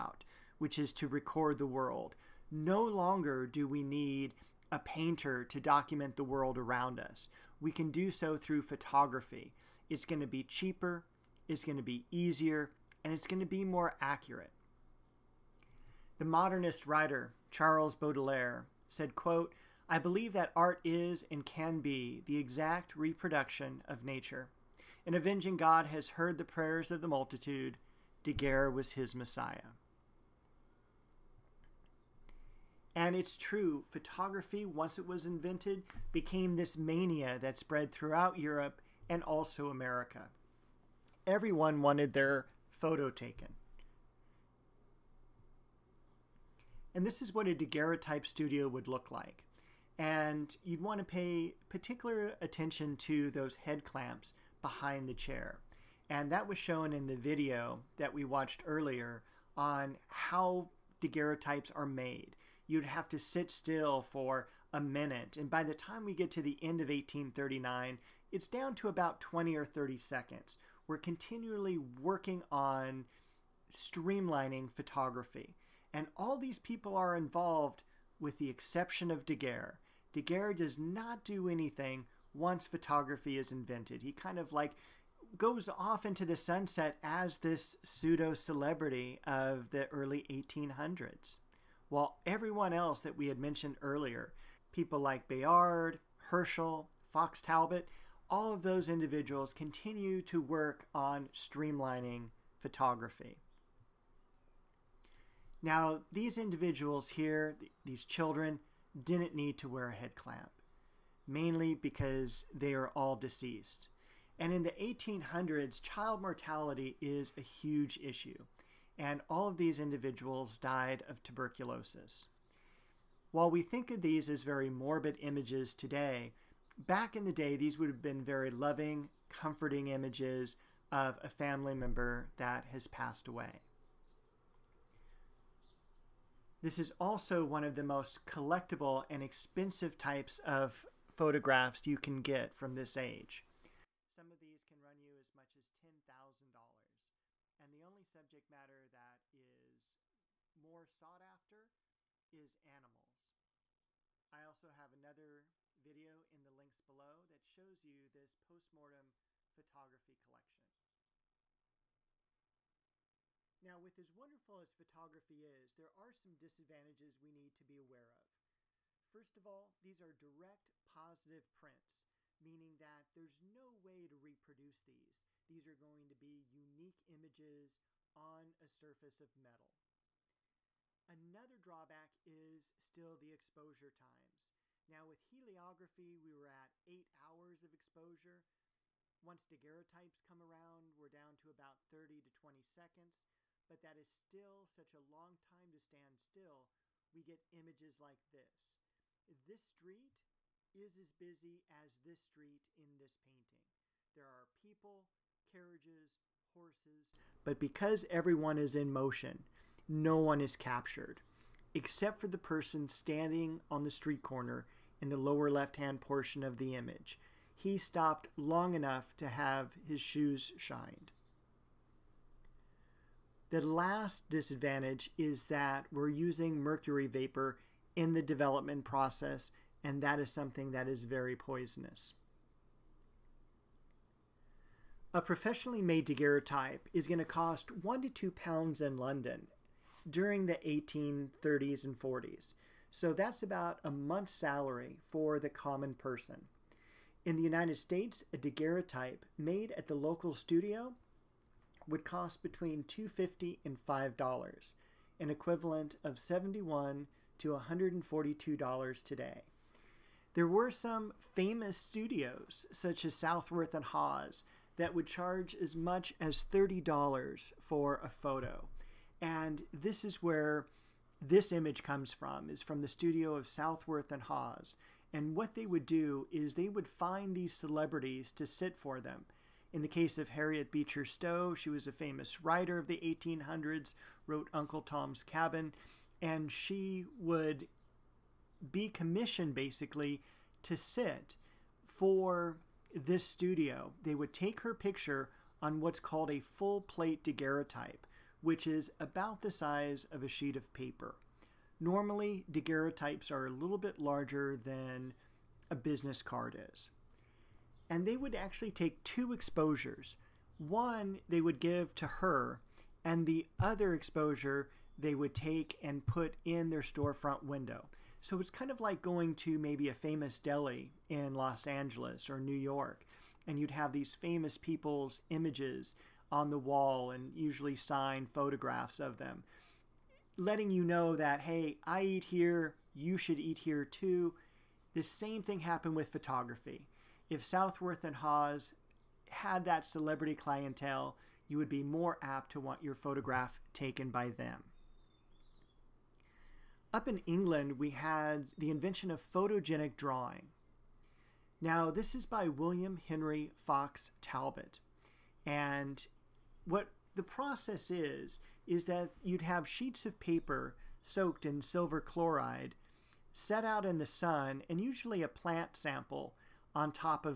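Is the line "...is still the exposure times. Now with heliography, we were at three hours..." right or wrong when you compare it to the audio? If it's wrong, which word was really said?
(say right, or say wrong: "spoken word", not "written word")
wrong: "eight", not "three".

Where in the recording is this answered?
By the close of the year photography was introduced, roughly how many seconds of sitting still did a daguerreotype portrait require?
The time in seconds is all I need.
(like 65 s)
69 s.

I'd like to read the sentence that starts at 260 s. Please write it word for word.
There were some famous studios, such as Southworth and Hawes, that would charge as much as $30 for a photo.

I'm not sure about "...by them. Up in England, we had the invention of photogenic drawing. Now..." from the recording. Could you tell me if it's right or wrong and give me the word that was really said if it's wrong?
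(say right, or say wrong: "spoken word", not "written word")
right.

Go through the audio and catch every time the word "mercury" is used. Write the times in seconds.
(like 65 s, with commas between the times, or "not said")
226 s.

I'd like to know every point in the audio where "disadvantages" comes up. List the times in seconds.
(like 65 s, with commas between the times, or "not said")
166 s, 224 s.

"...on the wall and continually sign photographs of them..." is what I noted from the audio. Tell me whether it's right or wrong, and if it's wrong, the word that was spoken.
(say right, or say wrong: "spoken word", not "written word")
wrong: "usually", not "continually".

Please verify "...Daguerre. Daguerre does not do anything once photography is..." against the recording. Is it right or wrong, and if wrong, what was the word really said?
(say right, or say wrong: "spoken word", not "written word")
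right.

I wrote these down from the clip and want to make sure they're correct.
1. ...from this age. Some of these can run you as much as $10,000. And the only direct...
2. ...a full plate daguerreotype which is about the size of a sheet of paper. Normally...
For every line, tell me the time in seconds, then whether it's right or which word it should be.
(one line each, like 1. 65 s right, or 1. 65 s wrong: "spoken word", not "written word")
1. 142 s wrong: "subject", not "direct"
2. 296 s right.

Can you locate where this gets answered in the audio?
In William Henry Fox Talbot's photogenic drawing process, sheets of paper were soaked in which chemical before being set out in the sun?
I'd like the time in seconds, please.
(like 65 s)
361 s.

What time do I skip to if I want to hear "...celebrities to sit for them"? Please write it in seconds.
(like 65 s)
277 s.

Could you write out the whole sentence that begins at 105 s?
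Now, these individuals here, these children, didn't need to wear a head clamp, mainly because they are all deceased.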